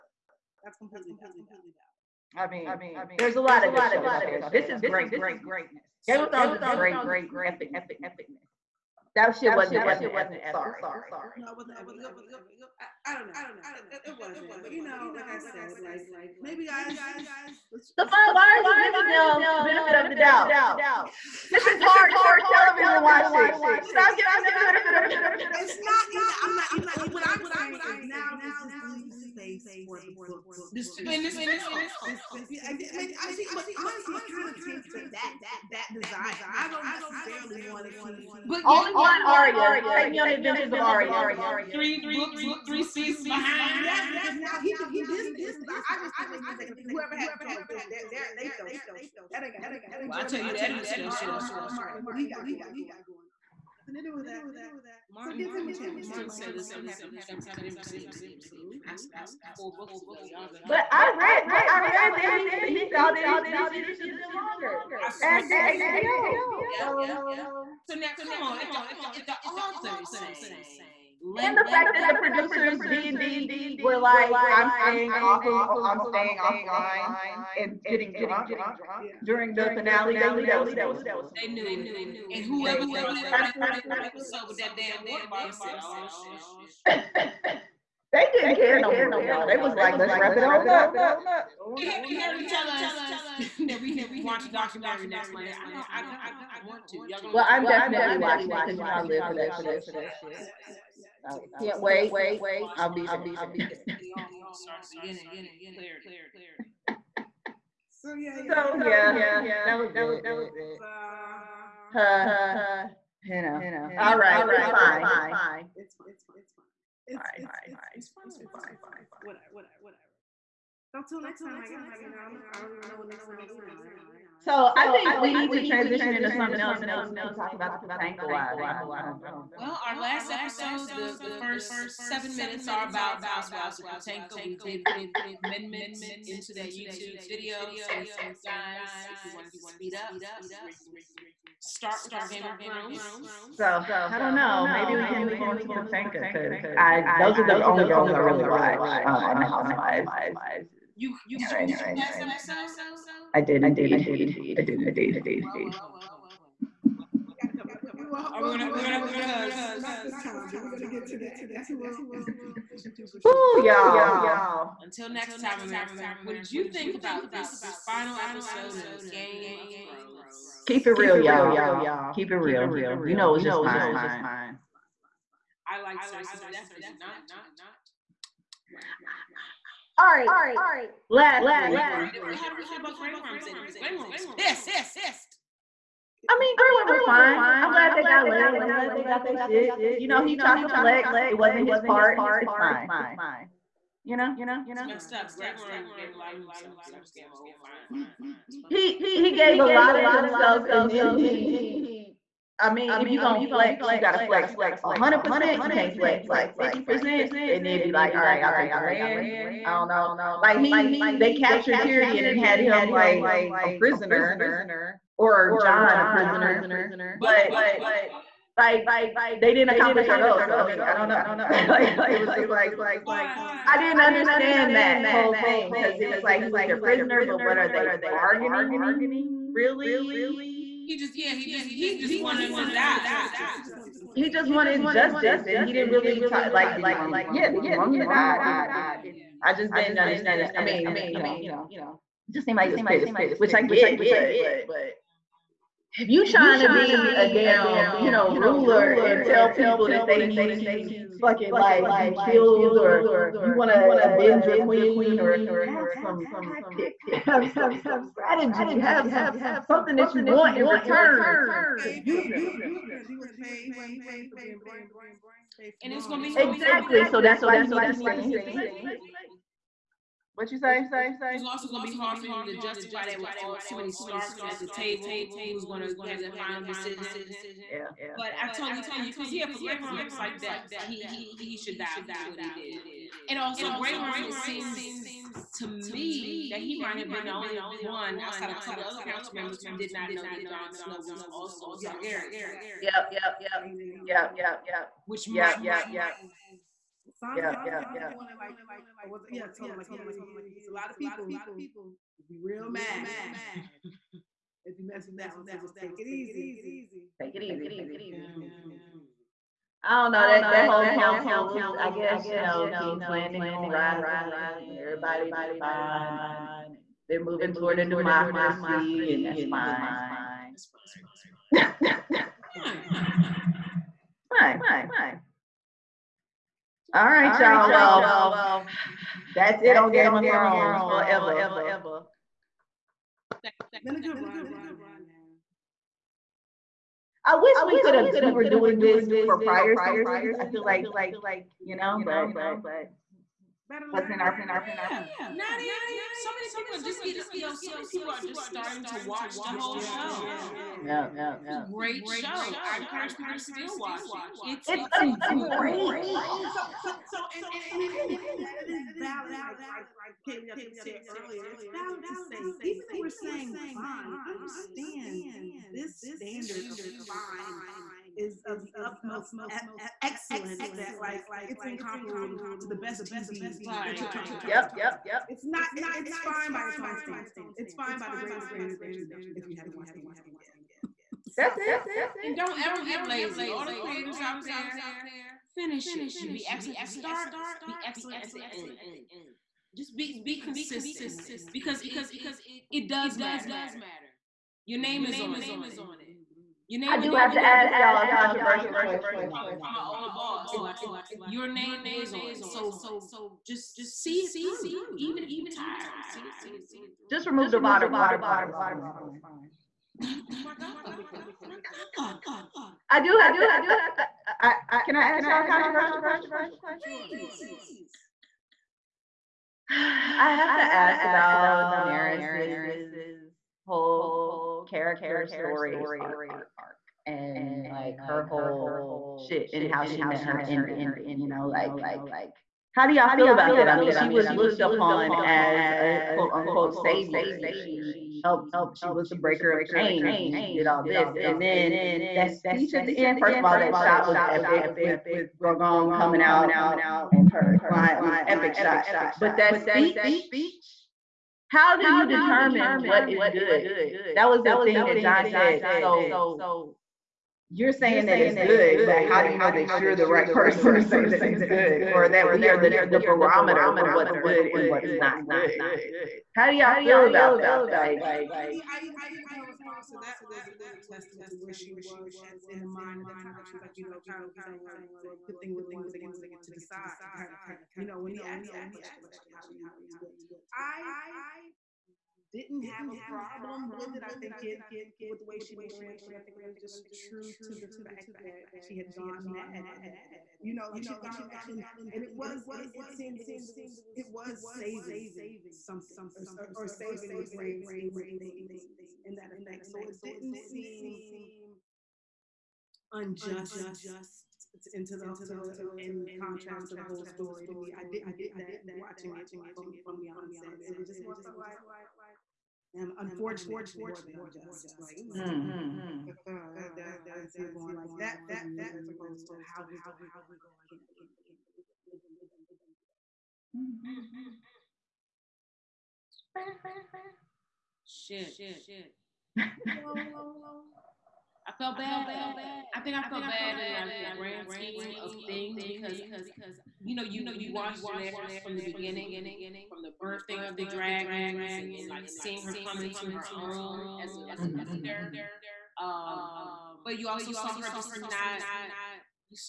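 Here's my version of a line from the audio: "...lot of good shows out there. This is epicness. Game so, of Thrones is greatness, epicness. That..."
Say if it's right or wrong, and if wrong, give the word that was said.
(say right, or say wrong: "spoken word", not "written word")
wrong: "greatness", not "epicness".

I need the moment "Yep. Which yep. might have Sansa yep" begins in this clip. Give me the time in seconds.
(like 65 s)
294 s.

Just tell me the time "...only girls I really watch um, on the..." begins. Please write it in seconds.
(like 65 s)
147 s.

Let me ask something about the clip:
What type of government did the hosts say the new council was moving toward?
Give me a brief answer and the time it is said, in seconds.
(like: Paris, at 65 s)
democracy, at 317 s.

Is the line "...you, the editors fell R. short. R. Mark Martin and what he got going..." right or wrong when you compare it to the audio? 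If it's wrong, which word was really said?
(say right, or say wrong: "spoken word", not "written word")
right.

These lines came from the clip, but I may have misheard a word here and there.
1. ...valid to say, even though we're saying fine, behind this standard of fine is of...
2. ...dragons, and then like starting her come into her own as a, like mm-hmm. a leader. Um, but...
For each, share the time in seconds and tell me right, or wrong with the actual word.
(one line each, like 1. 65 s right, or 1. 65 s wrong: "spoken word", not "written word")
1. 361 s wrong: "understand", not "behind"
2. 540 s wrong: "seeing", not "starting".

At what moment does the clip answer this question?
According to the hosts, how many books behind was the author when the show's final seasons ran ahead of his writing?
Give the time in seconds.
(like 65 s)
41 s.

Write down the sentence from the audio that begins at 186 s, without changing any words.
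I mean, Grey Worm was fine.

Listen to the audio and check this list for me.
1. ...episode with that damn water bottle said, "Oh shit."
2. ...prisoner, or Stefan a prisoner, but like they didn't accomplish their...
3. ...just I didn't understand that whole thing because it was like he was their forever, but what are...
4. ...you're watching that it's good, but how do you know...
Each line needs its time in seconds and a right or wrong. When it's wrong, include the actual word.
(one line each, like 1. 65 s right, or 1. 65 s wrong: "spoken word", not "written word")
1. 83 s right
2. 213 s wrong: "Jon", not "Stefan"
3. 223 s wrong: "prisoner", not "forever"
4. 457 s wrong: "saying", not "watching".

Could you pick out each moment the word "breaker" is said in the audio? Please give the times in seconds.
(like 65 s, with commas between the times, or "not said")
439 s.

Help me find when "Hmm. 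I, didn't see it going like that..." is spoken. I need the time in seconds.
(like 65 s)
515 s.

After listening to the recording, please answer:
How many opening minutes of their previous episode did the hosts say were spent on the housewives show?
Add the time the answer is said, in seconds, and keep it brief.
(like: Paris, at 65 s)
7, at 131 s.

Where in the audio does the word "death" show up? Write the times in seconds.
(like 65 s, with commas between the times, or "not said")
176 s, 280 s.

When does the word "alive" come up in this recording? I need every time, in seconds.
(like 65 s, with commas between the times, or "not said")
not said.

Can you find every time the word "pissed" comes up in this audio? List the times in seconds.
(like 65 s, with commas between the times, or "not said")
184 s, 242 s.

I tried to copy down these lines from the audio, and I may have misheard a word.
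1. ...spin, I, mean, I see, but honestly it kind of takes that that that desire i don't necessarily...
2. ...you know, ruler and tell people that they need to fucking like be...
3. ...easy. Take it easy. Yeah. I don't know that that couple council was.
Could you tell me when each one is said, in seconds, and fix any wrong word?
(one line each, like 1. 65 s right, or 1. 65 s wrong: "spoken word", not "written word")
1. 32 s right
2. 247 s right
3. 306 s wrong: "whole", not "couple".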